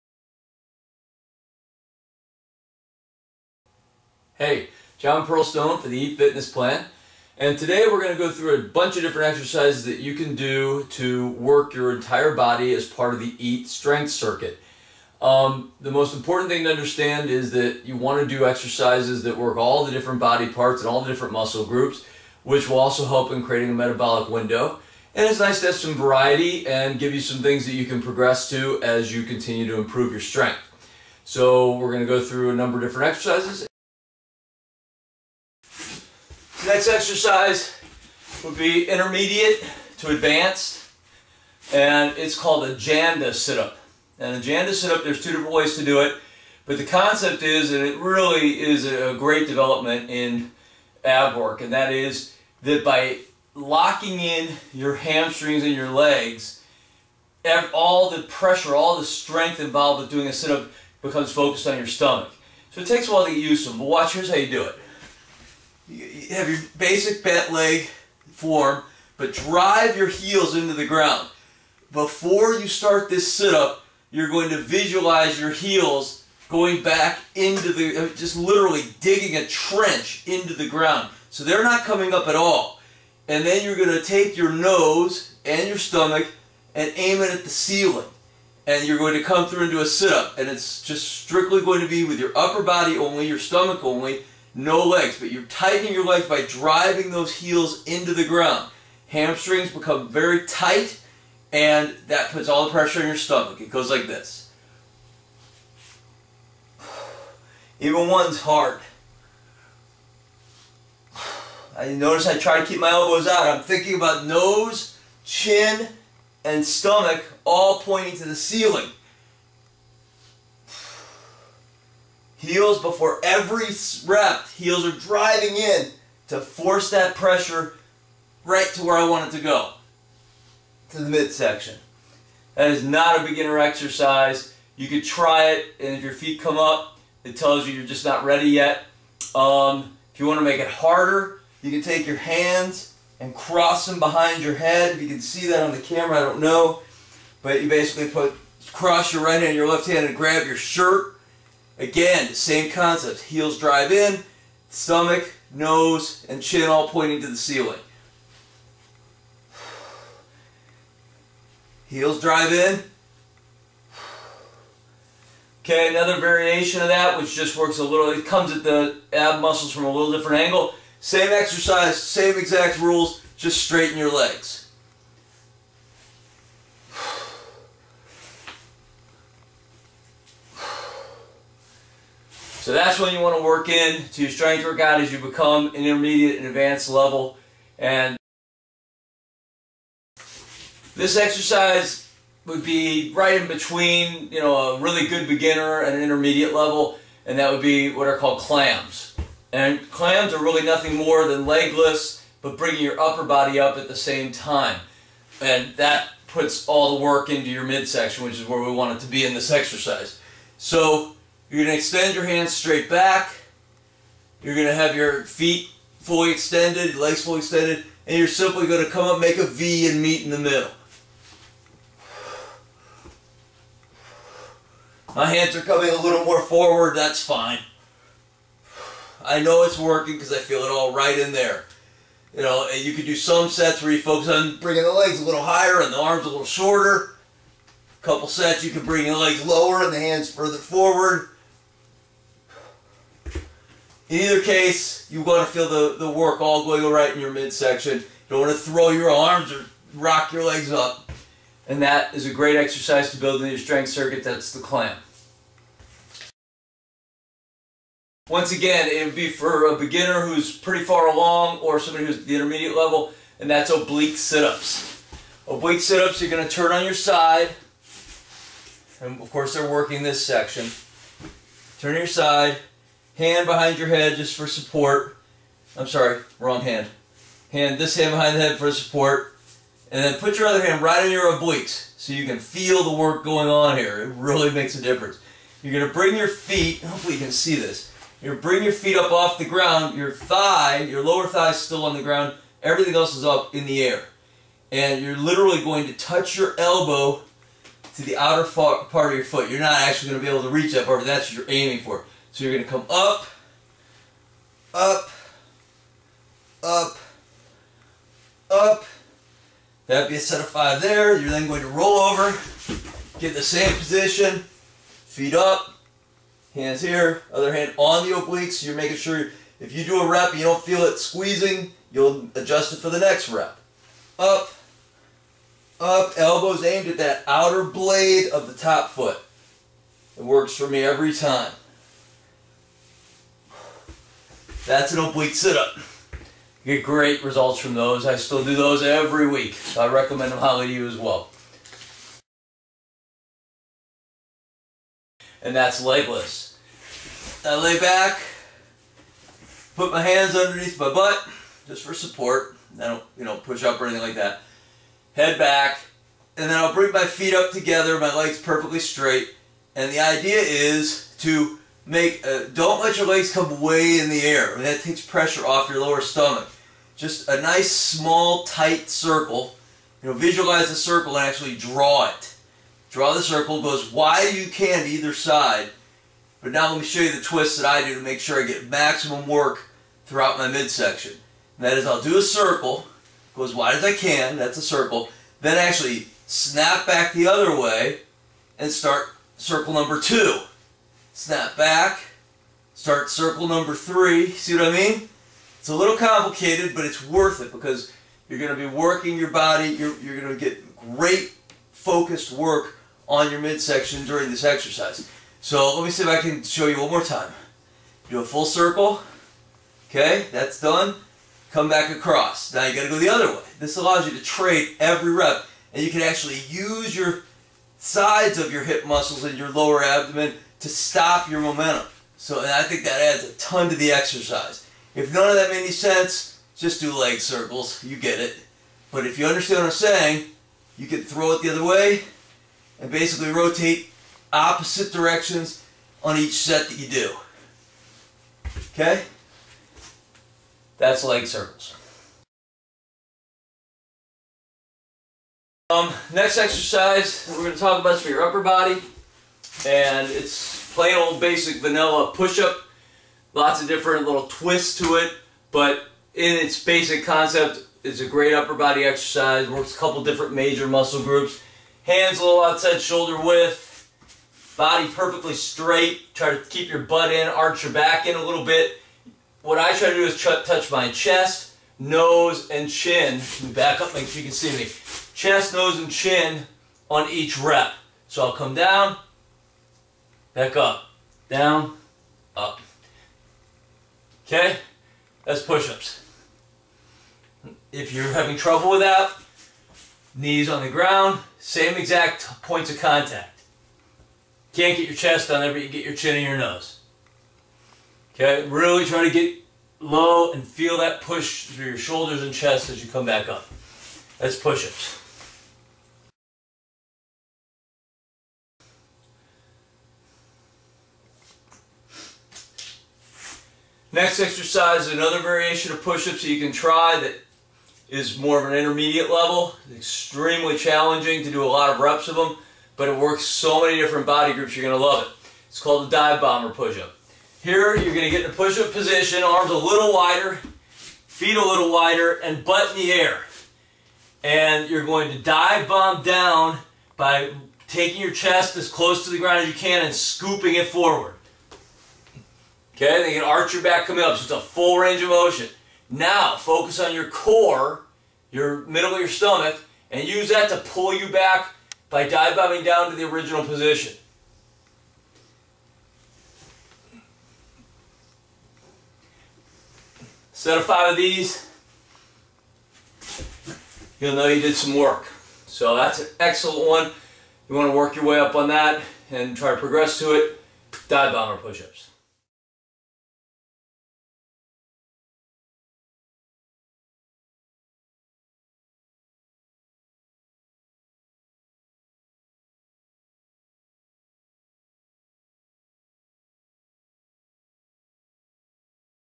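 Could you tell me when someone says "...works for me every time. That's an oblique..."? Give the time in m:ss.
5:30.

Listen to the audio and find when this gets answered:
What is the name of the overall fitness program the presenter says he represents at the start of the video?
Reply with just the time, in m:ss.
0:05.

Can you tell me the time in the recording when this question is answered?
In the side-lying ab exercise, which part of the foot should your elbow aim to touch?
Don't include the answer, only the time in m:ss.
4:58.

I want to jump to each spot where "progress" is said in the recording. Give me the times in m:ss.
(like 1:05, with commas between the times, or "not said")
0:28, 9:29.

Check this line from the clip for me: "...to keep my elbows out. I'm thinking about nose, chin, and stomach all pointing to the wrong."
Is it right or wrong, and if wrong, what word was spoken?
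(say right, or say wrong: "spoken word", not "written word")
wrong: "ceiling", not "wrong".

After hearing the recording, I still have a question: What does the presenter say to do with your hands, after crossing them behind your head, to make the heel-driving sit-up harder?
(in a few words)
grab your shirt.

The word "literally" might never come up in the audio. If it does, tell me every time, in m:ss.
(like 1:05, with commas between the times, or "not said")
1:18, 4:55.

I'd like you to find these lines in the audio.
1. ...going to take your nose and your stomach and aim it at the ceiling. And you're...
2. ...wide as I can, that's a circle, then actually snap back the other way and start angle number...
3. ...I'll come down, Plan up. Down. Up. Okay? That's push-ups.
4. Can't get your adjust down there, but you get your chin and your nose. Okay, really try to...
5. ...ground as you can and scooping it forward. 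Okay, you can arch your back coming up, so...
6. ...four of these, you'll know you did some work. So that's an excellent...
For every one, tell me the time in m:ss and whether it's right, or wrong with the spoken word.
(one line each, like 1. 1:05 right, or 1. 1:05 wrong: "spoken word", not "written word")
1. 1:23 right
2. 6:23 wrong: "circle", not "angle"
3. 7:58 wrong: "Back", not "Plan"
4. 8:14 wrong: "chest", not "adjust"
5. 8:59 right
6. 9:20 wrong: "five", not "four".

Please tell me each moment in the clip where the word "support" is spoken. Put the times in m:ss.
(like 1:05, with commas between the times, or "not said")
4:34, 4:38, 5:51.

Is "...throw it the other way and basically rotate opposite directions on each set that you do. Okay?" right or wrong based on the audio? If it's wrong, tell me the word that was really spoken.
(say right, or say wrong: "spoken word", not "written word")
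right.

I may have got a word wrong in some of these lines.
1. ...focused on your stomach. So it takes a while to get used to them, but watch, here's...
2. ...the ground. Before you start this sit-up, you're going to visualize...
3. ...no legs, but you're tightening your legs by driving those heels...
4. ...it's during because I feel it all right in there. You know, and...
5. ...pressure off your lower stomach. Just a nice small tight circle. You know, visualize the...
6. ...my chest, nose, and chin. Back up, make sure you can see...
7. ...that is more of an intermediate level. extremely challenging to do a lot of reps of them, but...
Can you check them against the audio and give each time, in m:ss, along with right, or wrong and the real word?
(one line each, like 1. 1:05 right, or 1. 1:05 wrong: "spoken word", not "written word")
1. 1:01 right
2. 1:10 right
3. 1:34 right
4. 3:49 wrong: "working", not "during"
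5. 6:05 right
6. 7:50 right
7. 8:37 right.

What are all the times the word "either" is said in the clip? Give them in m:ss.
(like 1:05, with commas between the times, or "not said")
4:04, 6:14.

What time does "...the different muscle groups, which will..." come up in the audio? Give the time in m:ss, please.
0:21.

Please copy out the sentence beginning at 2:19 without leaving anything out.
Um, if you want to make it harder, you can take your hands and cross them behind your head.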